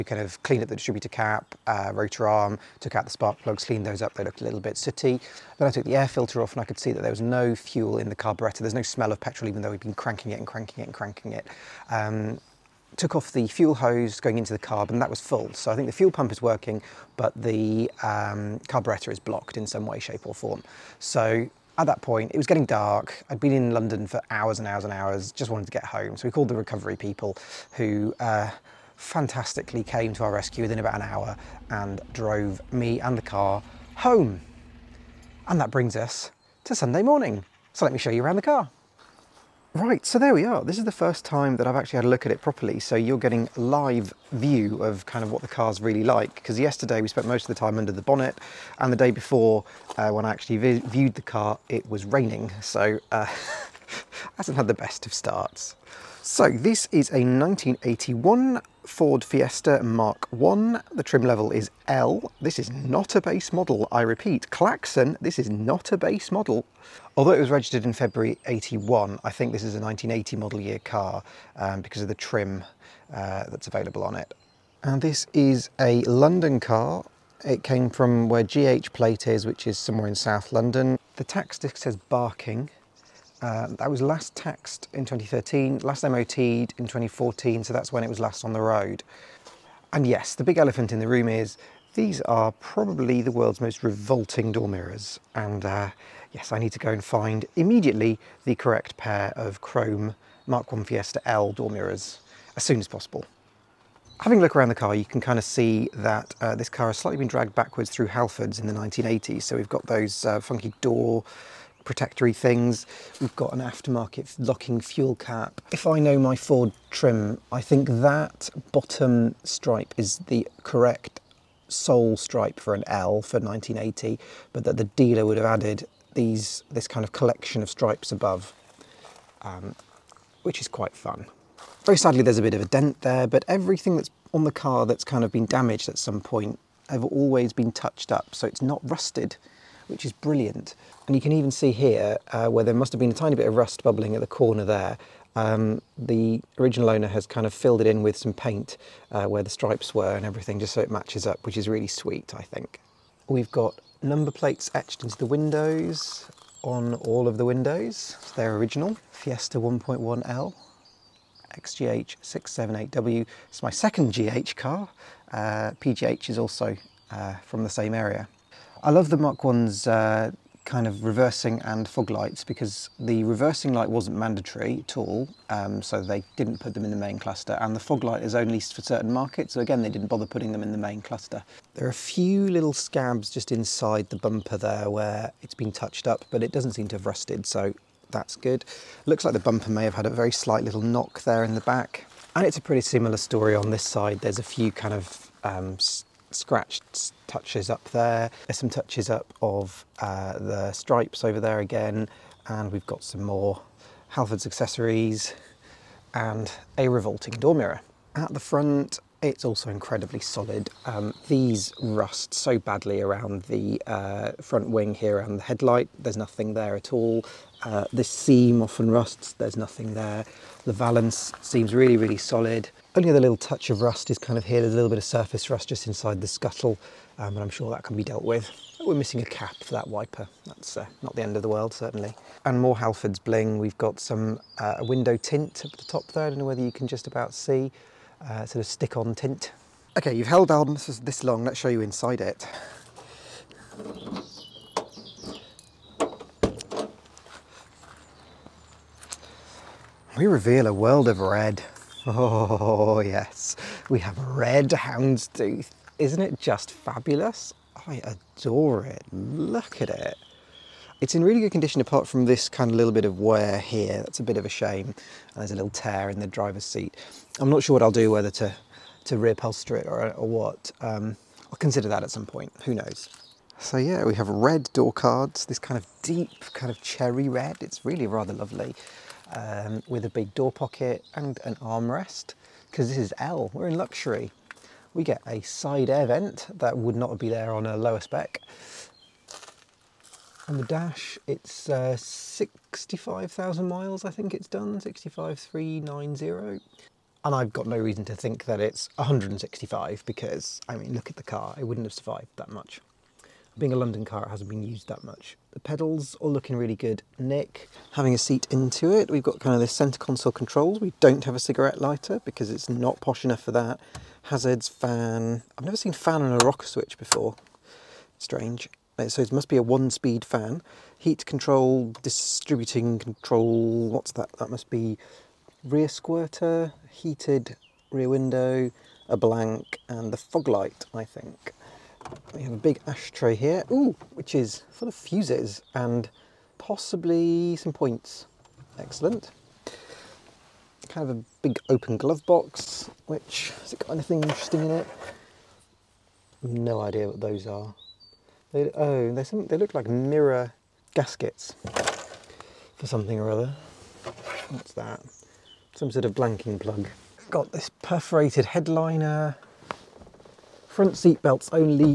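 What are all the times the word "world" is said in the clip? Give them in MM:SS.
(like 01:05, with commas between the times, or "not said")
01:33, 03:51, 04:10.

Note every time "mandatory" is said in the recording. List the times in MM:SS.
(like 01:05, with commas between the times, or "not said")
02:54.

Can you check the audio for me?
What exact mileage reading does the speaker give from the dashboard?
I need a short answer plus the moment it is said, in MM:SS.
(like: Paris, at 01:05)
65,390, at 04:54.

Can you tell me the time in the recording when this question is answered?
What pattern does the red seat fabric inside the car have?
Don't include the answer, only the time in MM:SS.
04:14.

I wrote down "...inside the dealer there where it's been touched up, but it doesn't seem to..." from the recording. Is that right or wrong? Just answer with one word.
wrong.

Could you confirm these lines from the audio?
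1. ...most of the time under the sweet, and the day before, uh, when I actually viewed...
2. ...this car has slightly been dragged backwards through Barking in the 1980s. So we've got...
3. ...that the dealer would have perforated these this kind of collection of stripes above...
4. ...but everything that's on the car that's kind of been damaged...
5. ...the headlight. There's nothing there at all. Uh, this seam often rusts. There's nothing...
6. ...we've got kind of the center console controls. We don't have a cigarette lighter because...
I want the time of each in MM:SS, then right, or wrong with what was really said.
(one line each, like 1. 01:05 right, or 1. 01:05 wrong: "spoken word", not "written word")
1. 00:47 wrong: "bonnet", not "sweet"
2. 01:46 wrong: "Halfords", not "Barking"
3. 02:04 wrong: "added", not "perforated"
4. 02:13 right
5. 03:35 right
6. 05:09 right.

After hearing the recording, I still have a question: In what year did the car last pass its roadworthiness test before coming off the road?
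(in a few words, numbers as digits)
2014.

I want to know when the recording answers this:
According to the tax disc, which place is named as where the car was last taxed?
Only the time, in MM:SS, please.
01:21.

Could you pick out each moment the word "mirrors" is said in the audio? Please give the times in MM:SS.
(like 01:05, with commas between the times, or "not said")
01:34, 01:41, 03:27, 05:49.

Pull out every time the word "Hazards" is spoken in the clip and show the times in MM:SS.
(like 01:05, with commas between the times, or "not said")
05:14.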